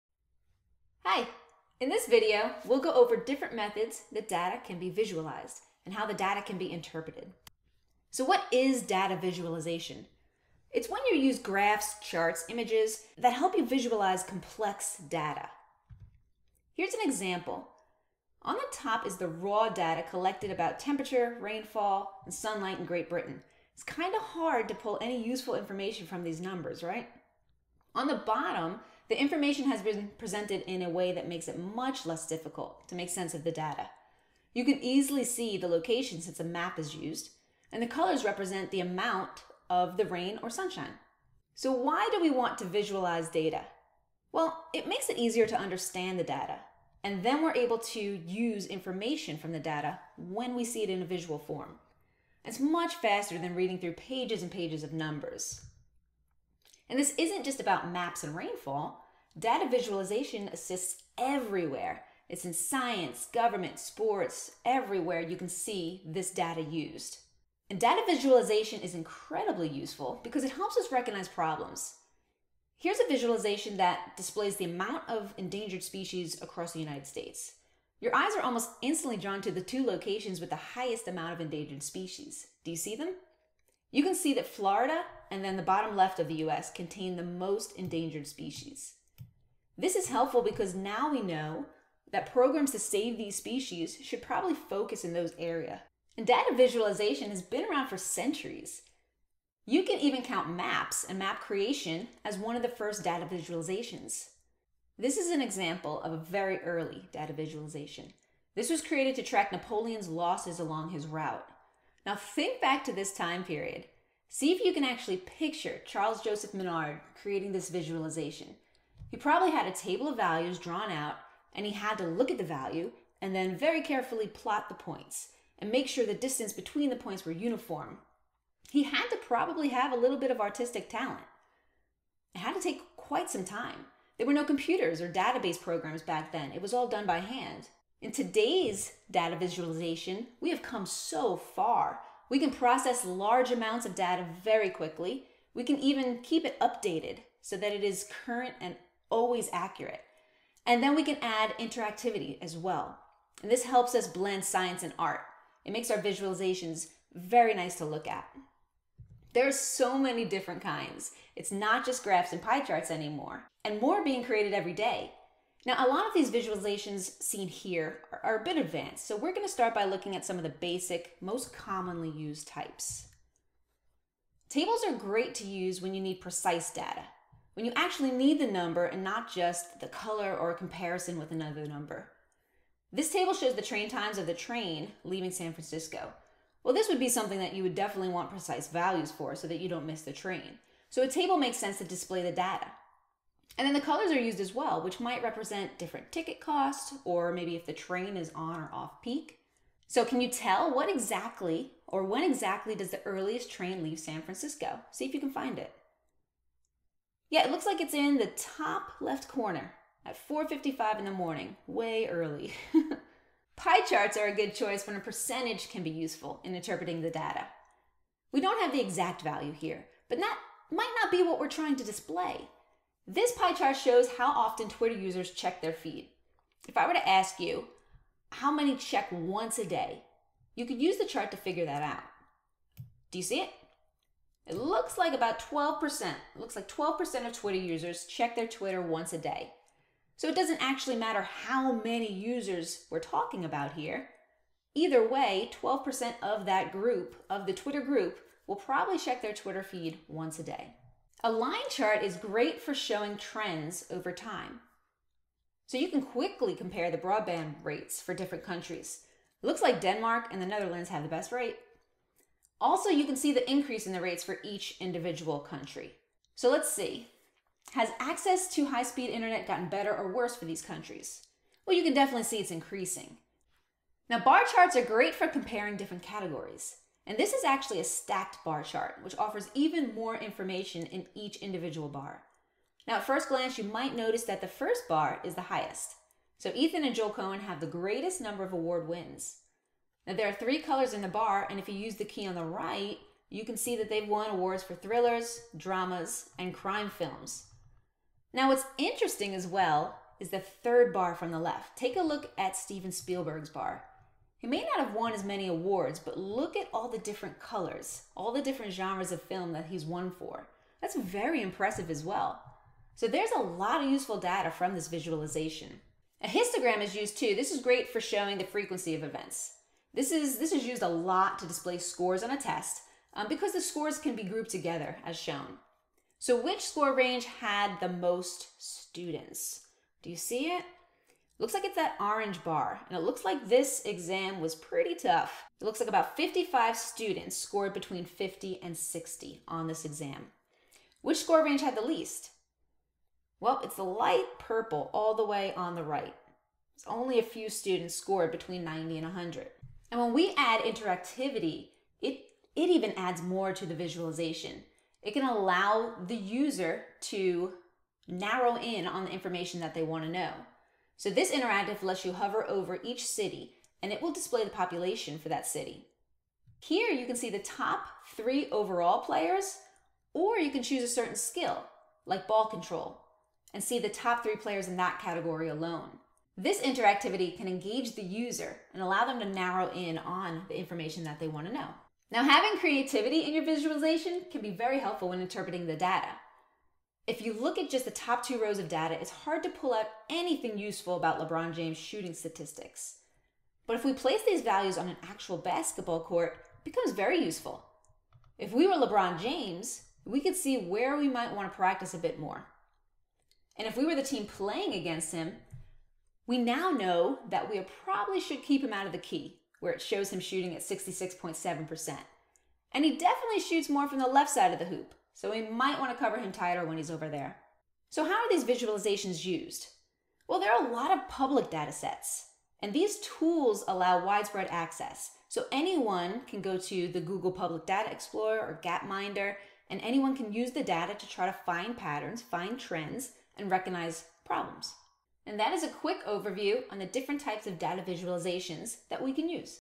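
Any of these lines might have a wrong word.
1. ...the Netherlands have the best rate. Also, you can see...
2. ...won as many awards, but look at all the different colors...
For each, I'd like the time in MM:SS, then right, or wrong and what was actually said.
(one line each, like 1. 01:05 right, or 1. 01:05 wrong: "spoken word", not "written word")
1. 04:20 right
2. 05:04 right.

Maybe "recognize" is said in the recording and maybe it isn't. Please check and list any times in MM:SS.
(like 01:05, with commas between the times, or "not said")
01:10, 07:13.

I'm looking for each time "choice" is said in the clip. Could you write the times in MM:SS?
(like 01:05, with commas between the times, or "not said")
03:34.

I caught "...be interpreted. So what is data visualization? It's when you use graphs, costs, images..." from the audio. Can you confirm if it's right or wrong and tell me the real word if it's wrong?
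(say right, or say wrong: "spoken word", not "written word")
wrong: "charts", not "costs".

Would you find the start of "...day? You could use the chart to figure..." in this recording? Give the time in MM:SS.
03:49.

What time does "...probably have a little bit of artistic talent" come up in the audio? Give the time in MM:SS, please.
02:09.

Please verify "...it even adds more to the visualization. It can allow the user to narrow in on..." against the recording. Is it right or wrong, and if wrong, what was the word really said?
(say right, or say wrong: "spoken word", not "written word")
right.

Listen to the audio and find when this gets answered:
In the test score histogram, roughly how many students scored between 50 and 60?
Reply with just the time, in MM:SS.
05:36.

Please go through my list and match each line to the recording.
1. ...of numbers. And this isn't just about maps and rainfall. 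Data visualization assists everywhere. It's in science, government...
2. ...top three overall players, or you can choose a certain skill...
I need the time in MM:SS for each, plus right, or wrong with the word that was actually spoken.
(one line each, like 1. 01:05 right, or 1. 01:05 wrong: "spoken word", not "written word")
1. 00:54 right
2. 06:07 right.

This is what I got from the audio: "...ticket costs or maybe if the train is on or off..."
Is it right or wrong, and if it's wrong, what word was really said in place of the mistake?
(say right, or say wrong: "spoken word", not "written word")
right.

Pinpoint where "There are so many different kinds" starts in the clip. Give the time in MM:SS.
02:39.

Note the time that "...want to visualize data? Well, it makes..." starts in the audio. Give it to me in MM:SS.
00:42.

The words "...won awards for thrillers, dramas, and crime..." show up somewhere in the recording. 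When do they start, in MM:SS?
04:54.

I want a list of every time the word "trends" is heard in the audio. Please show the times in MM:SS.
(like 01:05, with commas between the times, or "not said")
04:13, 07:12.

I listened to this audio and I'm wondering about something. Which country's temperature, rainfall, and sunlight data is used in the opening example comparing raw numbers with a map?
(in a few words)
Great Britain.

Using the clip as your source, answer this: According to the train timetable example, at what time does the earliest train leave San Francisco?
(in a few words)
4:55.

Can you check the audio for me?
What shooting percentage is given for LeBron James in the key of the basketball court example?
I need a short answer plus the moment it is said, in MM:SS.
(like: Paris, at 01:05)
66.7%, at 06:50.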